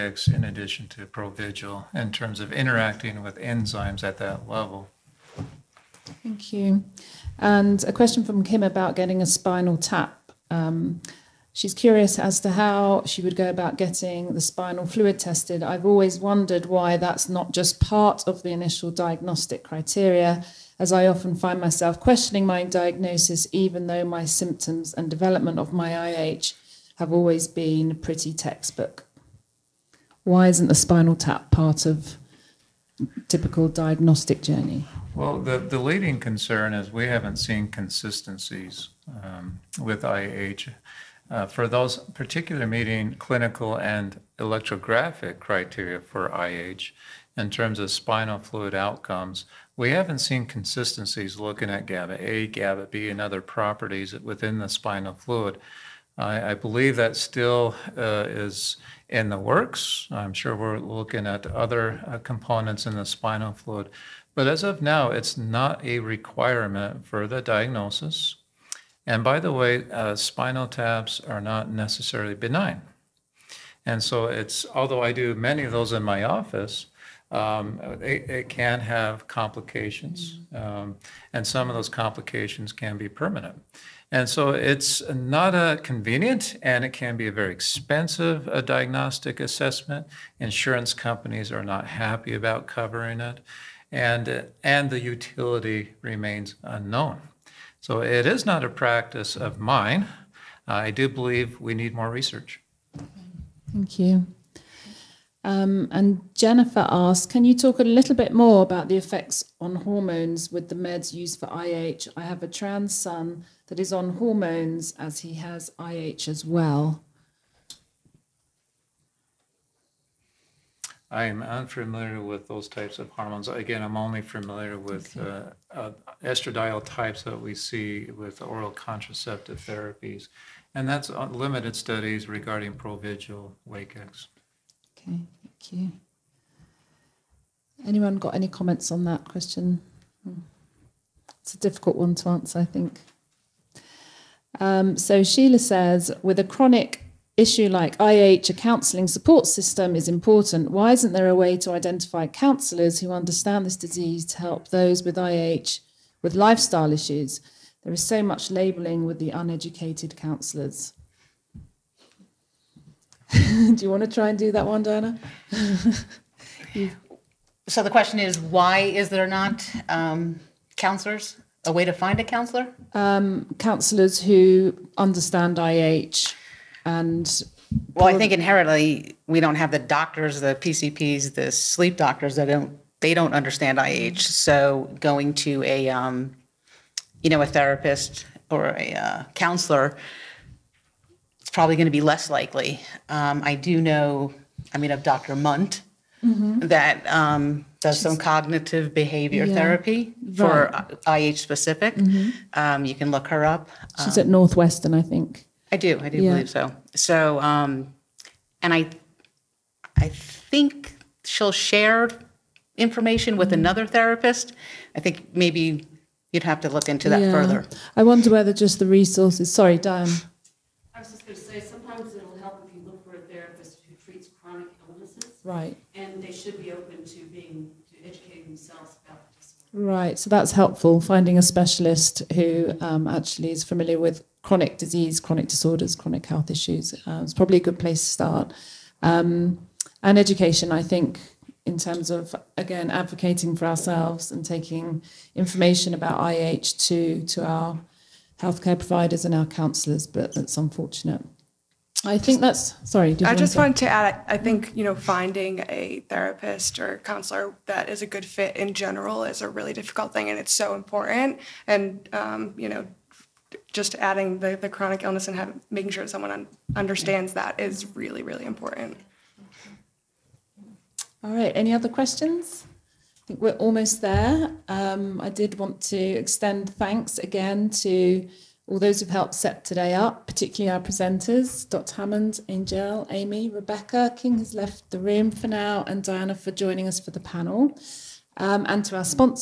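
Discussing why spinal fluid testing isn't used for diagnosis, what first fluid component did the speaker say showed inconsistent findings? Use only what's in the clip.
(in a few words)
GABA A.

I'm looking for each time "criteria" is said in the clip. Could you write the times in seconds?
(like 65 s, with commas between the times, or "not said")
19 s, 45 s.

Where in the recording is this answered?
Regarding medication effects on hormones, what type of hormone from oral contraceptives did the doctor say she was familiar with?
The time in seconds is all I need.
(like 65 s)
126 s.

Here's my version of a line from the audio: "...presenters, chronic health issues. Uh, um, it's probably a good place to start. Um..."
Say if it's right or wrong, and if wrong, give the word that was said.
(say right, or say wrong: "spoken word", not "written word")
wrong: "disorders", not "presenters".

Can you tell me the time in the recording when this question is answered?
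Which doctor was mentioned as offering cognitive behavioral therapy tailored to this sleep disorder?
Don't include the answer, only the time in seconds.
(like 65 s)
195 s.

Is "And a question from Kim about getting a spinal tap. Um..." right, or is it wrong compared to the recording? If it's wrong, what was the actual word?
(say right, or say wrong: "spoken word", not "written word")
right.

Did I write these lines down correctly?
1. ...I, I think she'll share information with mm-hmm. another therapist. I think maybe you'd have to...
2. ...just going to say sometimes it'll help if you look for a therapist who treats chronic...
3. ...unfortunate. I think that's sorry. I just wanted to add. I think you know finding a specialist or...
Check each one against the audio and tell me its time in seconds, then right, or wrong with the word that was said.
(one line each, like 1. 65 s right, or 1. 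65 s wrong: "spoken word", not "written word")
1. 208 s right
2. 221 s right
3. 250 s wrong: "therapist", not "specialist".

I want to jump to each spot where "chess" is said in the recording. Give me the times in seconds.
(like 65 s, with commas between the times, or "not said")
not said.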